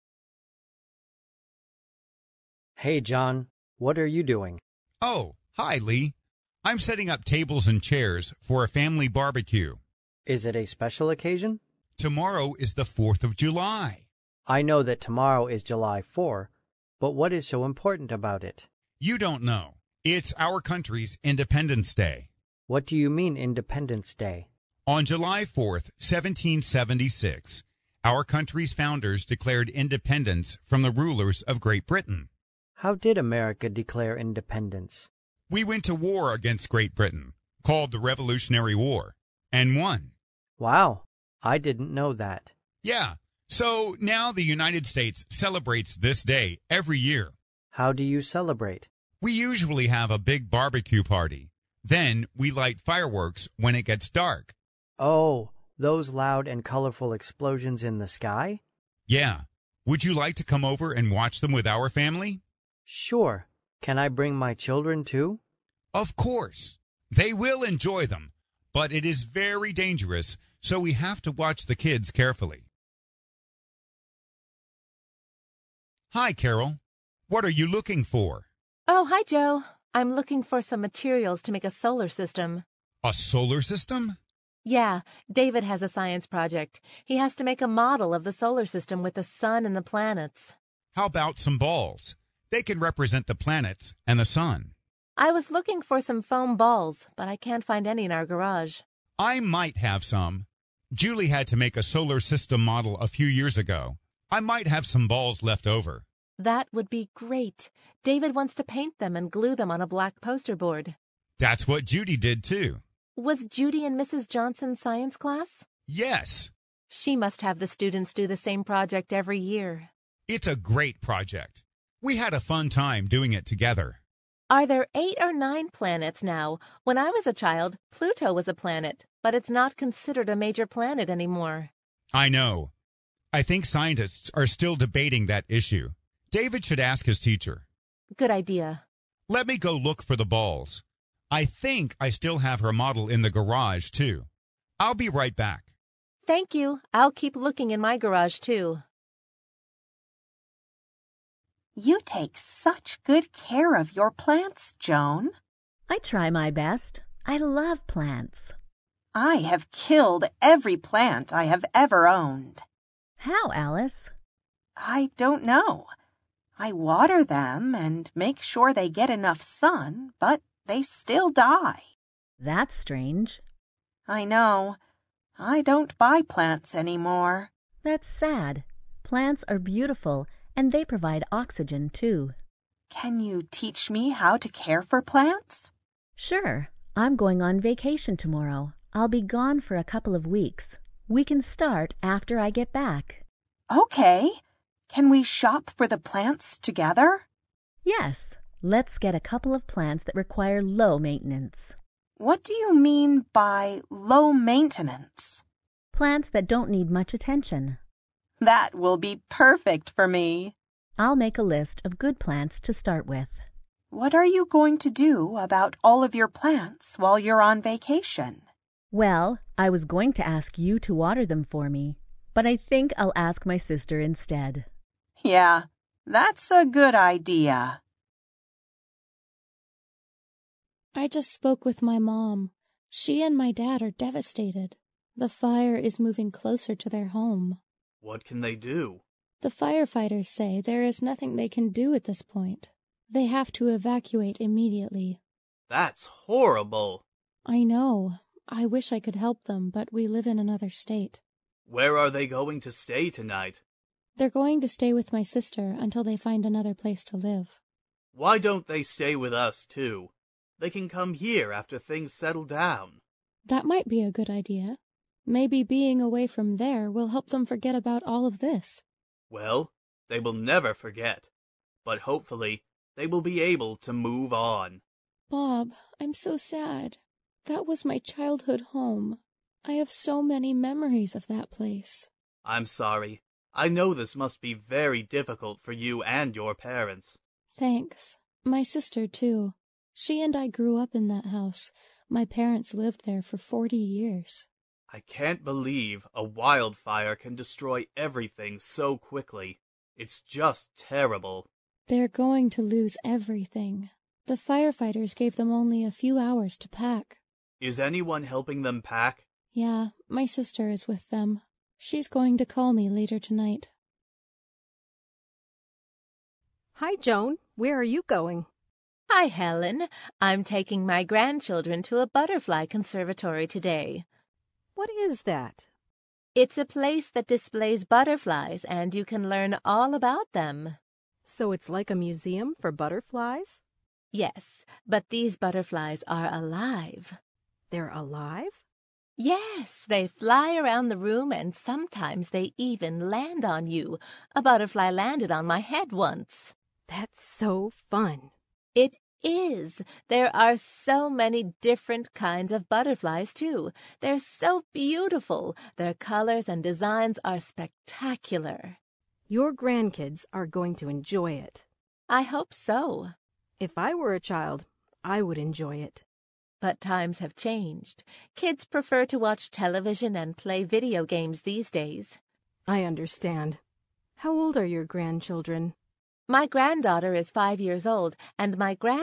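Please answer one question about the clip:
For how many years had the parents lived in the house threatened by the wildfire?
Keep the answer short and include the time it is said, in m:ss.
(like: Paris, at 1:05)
40, at 4:53.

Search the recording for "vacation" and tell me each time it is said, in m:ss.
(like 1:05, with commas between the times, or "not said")
3:07, 3:37.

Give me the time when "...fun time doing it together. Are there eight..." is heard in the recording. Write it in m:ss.
2:02.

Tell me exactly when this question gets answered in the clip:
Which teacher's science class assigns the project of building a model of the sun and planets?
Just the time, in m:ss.
1:53.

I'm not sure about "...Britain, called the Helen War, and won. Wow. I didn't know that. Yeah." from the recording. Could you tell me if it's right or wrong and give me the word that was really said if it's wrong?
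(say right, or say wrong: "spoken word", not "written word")
wrong: "Revolutionary", not "Helen".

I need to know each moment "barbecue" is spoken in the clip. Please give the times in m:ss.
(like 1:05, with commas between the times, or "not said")
0:09, 0:50.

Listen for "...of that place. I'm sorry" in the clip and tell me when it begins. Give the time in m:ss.
4:41.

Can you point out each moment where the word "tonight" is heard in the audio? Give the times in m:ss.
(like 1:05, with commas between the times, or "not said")
4:13, 5:13.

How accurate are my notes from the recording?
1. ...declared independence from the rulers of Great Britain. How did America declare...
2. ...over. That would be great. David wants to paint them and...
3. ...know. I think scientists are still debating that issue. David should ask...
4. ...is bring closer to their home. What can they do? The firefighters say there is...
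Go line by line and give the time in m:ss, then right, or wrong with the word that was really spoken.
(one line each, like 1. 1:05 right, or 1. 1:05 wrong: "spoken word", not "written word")
1. 0:29 right
2. 1:45 right
3. 2:12 right
4. 3:55 wrong: "moving", not "bring".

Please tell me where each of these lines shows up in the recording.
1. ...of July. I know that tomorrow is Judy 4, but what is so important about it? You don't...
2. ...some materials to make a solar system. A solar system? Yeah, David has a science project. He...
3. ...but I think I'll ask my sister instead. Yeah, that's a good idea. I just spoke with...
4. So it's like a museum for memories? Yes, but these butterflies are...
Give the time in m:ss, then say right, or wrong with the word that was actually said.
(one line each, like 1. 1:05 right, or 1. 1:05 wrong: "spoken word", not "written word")
1. 0:13 wrong: "July", not "Judy"
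2. 1:20 right
3. 3:42 right
4. 5:31 wrong: "butterflies", not "memories".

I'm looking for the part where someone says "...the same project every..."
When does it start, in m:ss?
1:58.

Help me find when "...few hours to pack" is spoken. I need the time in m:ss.
5:05.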